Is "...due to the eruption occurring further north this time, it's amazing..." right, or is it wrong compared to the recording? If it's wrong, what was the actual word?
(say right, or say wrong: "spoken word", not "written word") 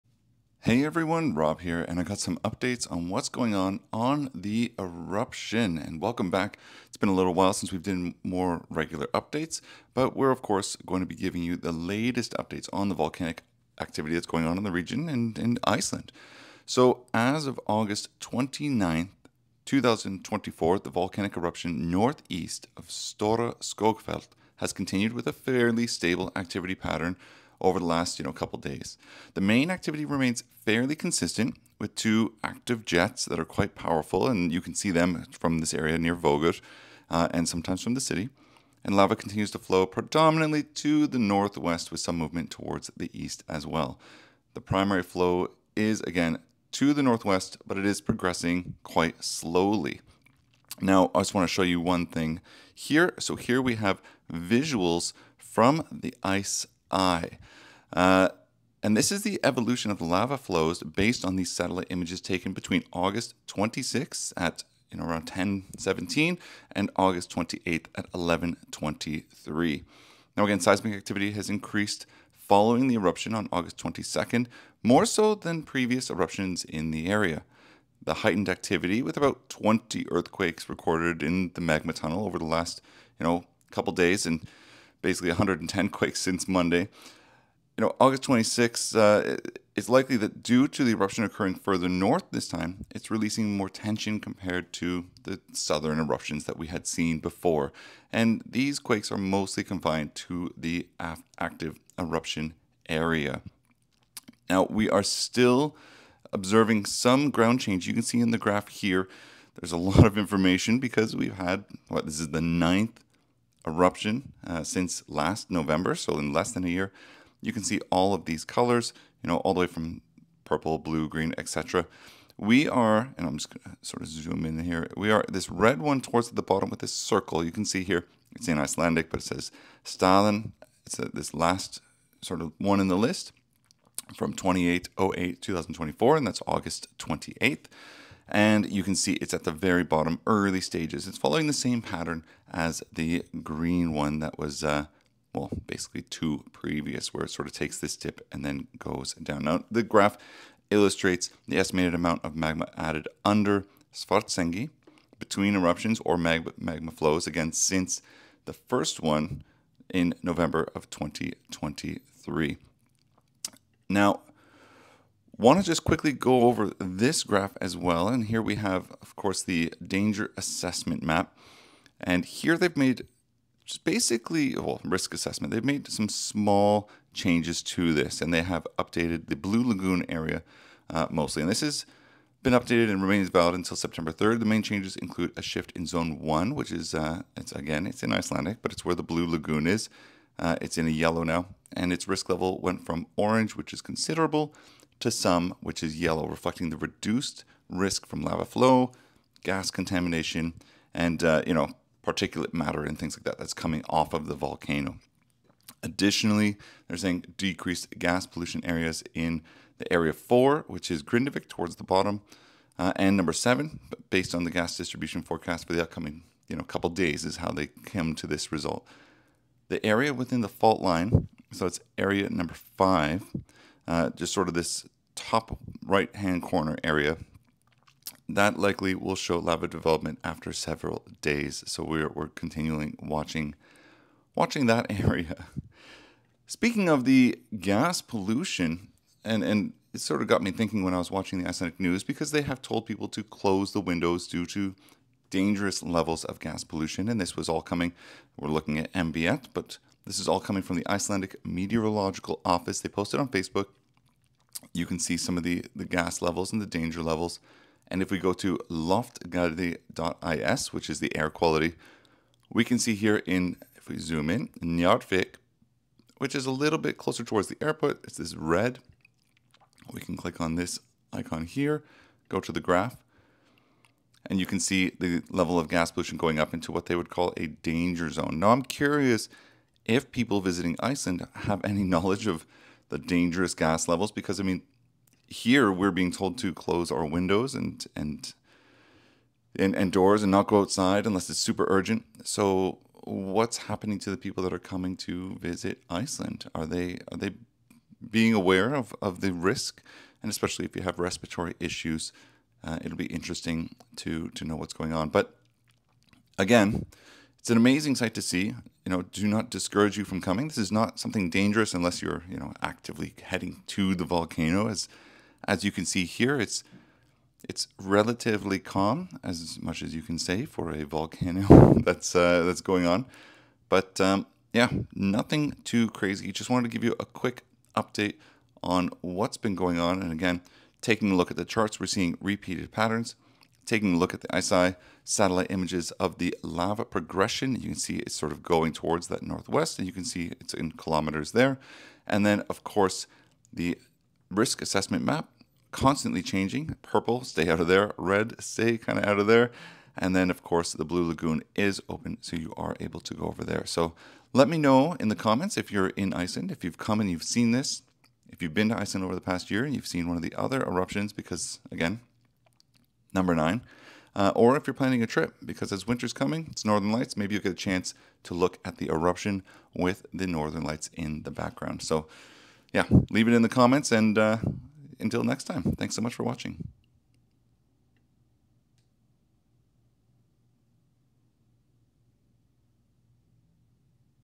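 wrong: "releasing", not "amazing".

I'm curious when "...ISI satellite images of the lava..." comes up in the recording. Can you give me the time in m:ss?
5:34.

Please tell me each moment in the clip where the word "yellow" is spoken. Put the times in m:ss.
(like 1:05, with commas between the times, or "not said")
3:10, 3:15.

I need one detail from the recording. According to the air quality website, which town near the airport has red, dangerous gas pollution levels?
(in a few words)
Njardvik.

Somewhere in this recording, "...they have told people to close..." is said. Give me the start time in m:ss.
4:02.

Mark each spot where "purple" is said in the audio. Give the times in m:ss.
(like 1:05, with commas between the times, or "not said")
2:00, 5:46.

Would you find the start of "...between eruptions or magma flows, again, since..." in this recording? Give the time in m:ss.
2:35.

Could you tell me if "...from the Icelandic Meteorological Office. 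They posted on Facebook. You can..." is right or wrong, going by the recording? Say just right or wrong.
right.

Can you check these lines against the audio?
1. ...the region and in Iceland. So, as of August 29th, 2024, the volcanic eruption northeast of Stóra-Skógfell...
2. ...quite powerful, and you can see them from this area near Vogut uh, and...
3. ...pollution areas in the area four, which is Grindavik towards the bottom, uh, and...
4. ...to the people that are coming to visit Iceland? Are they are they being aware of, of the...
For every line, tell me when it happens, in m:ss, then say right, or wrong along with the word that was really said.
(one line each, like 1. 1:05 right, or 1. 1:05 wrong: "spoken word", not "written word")
1. 0:14 right
2. 0:33 right
3. 3:28 right
4. 4:53 right.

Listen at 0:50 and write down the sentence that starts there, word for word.
Now, I just want to show you one thing here.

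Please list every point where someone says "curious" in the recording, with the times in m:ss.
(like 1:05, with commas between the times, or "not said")
4:38.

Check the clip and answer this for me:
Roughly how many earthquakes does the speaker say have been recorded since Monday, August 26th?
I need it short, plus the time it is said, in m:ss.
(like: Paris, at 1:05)
110, at 1:25.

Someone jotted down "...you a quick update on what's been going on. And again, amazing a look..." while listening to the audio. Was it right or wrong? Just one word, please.
wrong.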